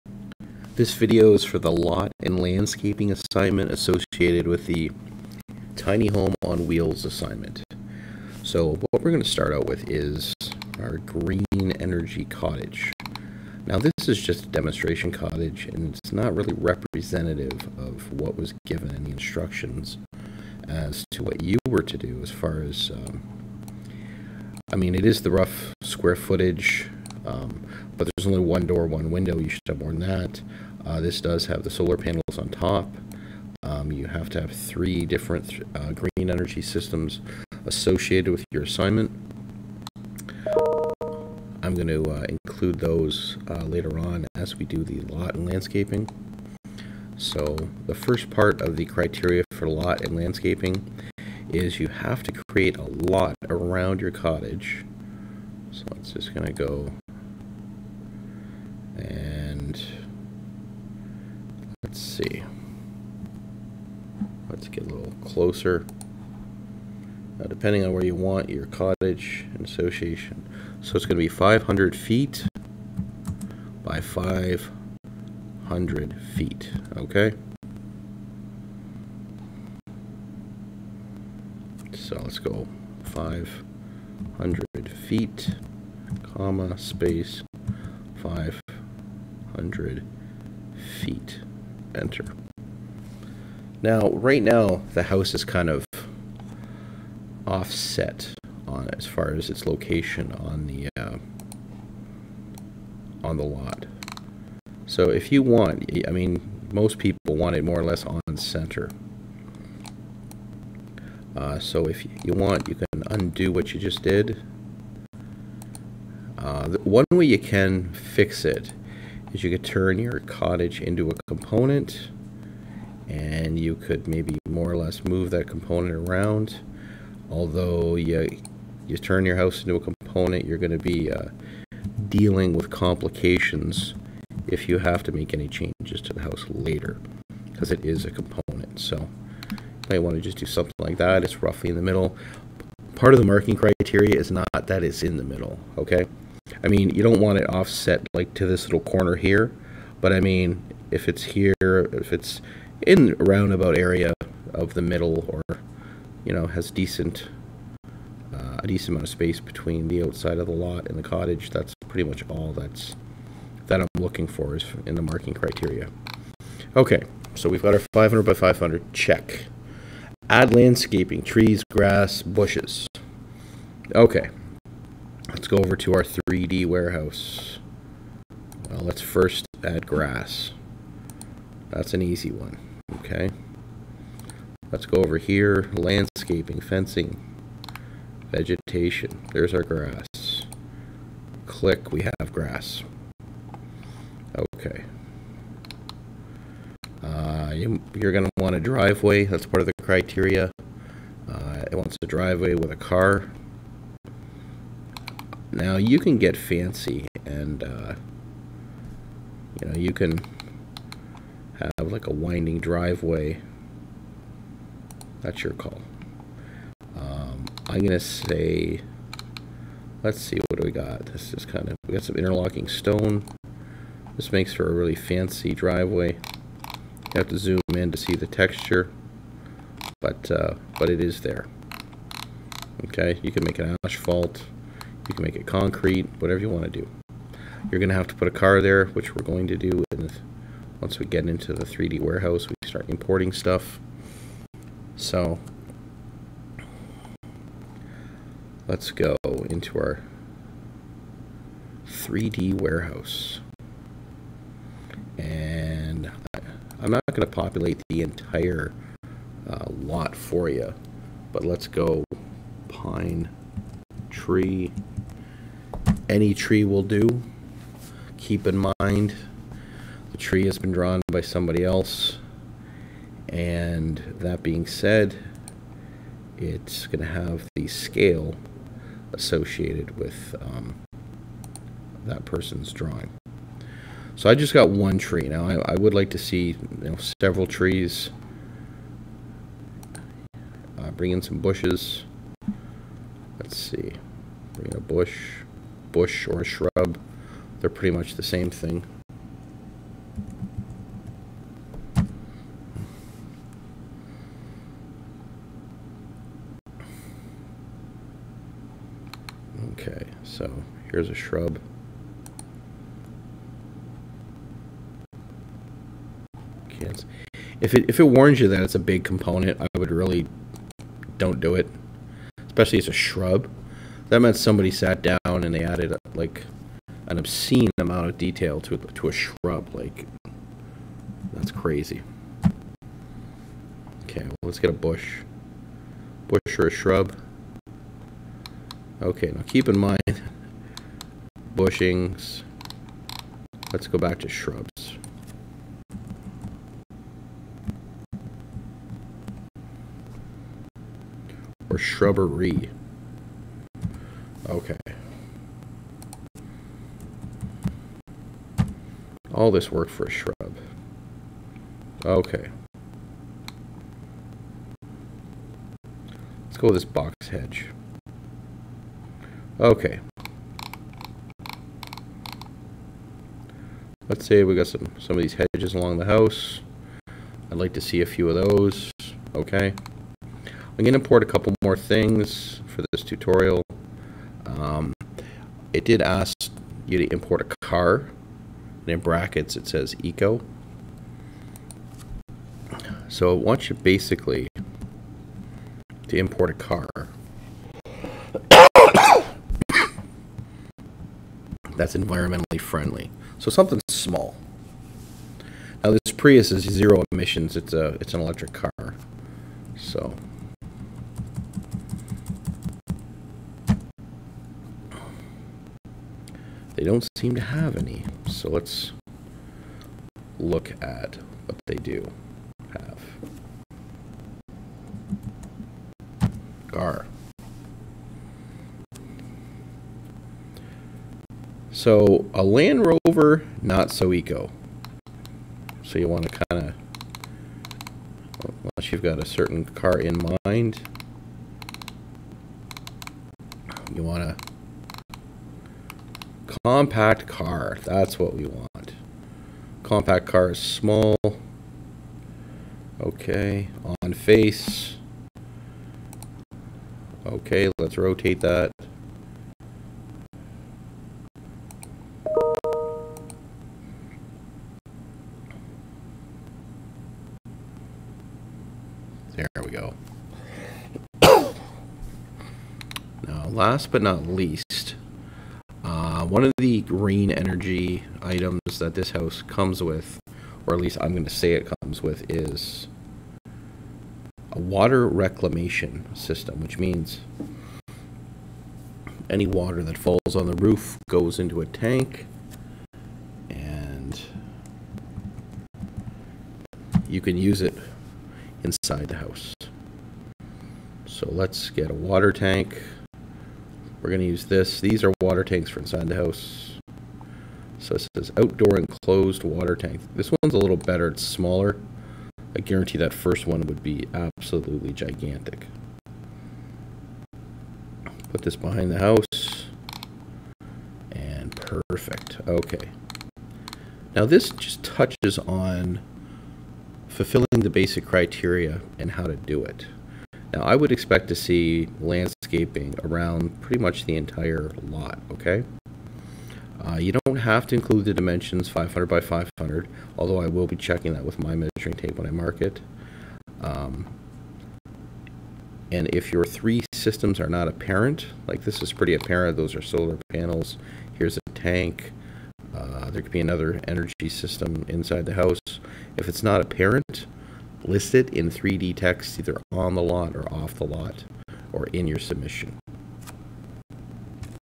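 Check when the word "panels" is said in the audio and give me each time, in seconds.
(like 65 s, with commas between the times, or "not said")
31 s, 550 s.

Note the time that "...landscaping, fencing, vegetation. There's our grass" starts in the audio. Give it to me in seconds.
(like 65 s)
185 s.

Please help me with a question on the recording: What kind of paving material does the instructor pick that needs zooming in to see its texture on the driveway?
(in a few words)
interlocking stone.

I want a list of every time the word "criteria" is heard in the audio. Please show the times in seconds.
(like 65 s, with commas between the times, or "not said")
48 s, 143 s, 165 s, 199 s, 528 s.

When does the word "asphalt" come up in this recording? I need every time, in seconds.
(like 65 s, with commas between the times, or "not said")
233 s.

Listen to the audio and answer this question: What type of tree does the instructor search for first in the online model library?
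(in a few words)
Pine tree.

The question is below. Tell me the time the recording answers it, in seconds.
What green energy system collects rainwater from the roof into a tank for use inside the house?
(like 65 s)
484 s.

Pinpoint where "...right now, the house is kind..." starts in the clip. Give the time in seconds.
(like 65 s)
94 s.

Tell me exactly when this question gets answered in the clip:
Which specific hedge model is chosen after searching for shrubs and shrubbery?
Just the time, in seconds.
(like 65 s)
366 s.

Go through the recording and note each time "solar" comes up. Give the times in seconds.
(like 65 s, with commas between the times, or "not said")
31 s, 549 s.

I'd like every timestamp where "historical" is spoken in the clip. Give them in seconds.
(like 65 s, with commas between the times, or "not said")
not said.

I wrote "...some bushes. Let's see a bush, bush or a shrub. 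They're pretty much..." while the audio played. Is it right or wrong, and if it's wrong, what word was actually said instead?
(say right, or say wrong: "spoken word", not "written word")
right.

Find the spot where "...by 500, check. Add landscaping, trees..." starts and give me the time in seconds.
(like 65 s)
168 s.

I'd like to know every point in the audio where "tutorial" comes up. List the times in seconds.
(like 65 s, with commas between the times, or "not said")
383 s.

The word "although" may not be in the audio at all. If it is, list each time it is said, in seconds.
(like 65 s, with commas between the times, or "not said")
127 s, 540 s.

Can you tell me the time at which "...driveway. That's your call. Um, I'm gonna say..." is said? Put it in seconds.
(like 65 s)
212 s.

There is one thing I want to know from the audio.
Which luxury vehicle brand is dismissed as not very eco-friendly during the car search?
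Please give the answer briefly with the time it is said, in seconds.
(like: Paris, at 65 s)
Land Rover, at 432 s.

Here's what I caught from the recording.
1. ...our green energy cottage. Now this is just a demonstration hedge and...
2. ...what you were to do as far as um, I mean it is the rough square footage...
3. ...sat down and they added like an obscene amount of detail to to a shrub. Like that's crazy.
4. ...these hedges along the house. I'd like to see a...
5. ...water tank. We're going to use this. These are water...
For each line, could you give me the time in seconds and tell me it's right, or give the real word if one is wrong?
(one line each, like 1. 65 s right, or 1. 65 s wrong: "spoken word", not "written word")
1. 10 s wrong: "cottage", not "hedge"
2. 21 s right
3. 324 s right
4. 375 s right
5. 501 s right.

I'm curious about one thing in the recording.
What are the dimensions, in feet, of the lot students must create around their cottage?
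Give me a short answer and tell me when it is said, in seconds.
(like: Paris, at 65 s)
500 by 500, at 71 s.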